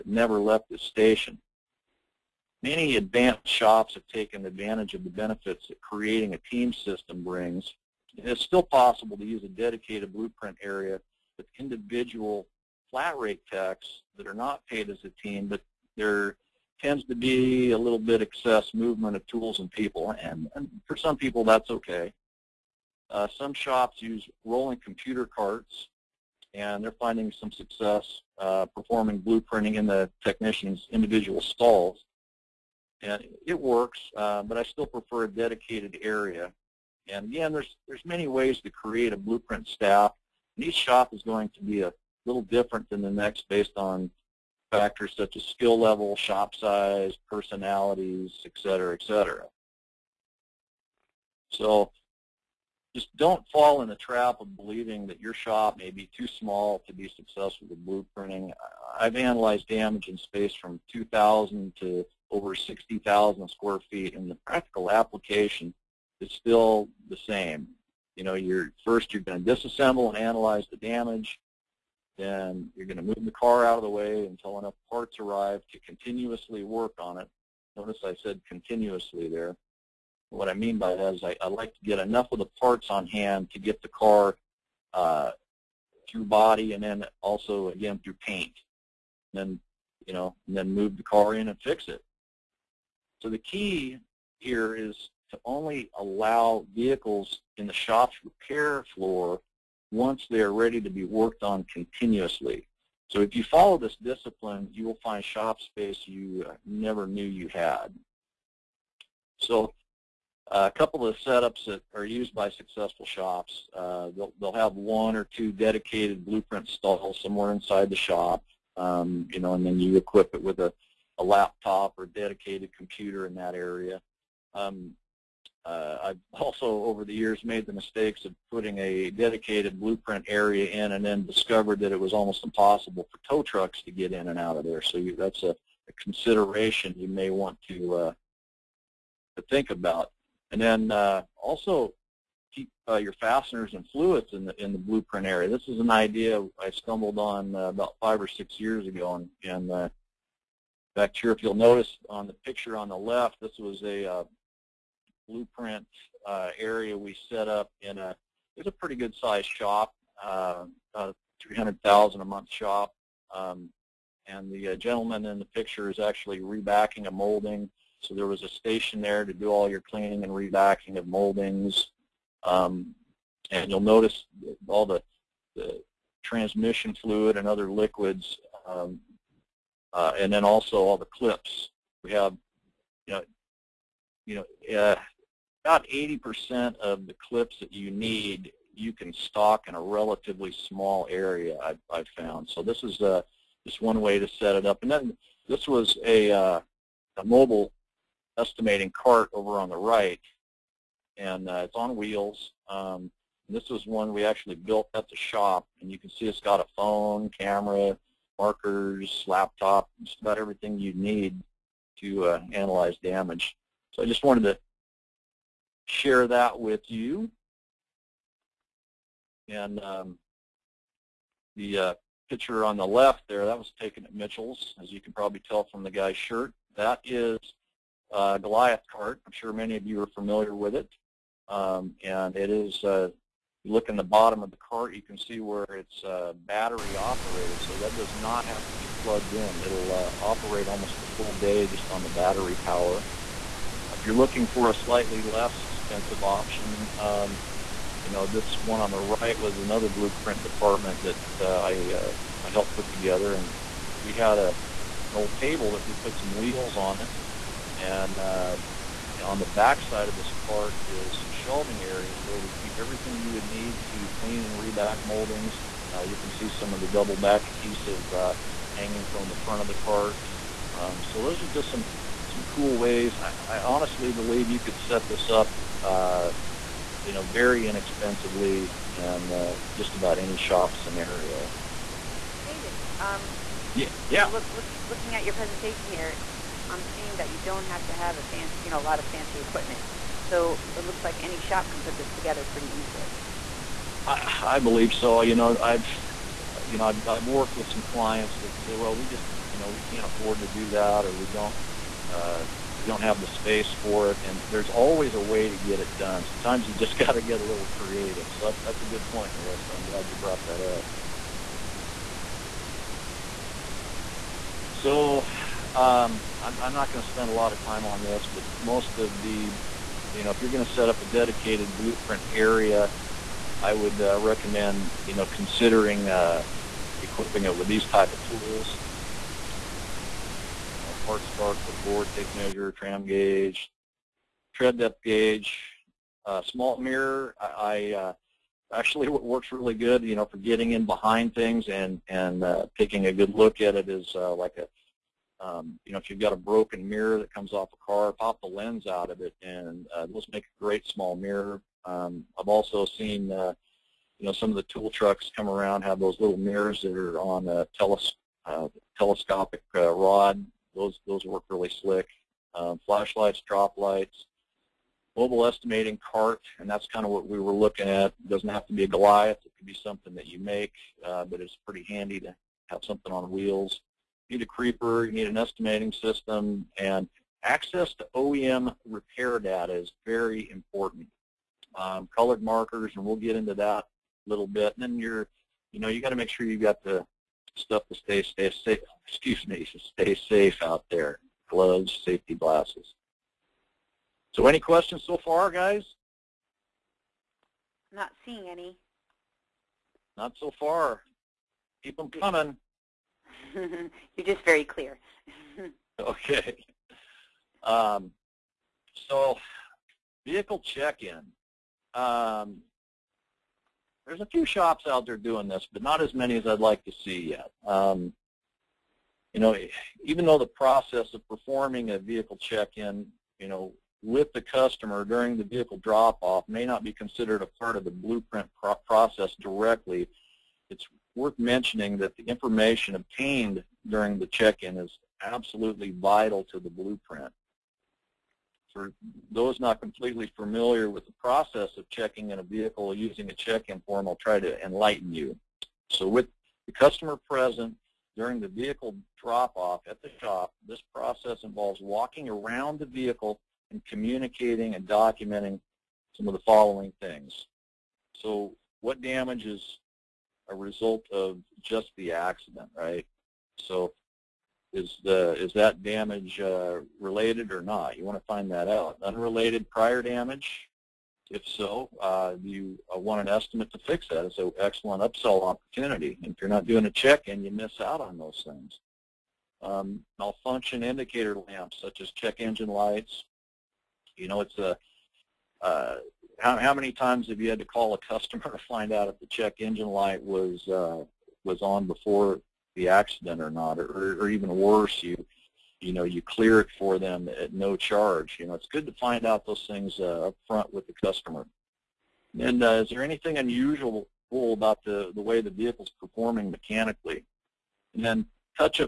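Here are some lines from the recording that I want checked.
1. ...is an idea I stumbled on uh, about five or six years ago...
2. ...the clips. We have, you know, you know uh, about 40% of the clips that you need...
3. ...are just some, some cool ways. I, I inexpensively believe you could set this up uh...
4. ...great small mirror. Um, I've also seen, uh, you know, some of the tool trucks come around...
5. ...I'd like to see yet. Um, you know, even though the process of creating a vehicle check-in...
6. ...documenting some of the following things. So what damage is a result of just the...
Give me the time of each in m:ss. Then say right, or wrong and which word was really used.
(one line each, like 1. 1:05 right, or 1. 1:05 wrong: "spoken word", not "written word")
1. 2:25 right
2. 3:00 wrong: "80", not "40"
3. 4:31 wrong: "honestly", not "inexpensively"
4. 5:50 right
5. 6:56 wrong: "performing", not "creating"
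6. 7:34 right.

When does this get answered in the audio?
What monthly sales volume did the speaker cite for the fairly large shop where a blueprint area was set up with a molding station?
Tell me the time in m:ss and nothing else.
2:41.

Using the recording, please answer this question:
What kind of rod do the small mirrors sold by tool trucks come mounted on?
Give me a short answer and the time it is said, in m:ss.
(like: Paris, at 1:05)
telescopic, at 5:58.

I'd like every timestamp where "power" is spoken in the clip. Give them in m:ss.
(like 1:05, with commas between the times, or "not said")
4:02.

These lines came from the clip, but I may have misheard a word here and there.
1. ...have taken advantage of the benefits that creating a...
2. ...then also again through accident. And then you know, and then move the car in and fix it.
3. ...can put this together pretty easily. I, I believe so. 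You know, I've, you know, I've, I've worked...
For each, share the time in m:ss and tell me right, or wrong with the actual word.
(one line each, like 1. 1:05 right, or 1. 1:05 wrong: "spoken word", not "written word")
1. 0:03 right
2. 1:26 wrong: "paint", not "accident"
3. 4:51 right.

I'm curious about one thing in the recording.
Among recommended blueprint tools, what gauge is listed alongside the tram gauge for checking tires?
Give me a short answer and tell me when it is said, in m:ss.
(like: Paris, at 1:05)
tread depth gauge, at 5:34.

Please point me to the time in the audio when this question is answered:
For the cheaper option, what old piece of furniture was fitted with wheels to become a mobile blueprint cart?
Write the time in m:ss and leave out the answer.
4:15.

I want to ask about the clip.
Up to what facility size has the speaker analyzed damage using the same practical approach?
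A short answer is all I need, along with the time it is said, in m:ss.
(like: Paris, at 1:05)
over 60,000 square feet, at 1:02.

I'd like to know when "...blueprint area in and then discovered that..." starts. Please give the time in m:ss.
2:09.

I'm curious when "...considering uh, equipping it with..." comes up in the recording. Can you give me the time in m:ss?
5:25.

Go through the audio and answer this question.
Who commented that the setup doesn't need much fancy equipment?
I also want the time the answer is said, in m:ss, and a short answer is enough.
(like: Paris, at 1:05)
Melissa, at 5:09.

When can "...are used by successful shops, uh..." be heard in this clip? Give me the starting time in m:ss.
1:51.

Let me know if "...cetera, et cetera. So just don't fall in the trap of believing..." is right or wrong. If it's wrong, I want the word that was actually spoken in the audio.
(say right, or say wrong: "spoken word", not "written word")
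right.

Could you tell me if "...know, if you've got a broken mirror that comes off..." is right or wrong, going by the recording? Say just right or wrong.
right.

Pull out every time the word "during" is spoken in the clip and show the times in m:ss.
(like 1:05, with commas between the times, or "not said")
7:05, 7:13, 7:28.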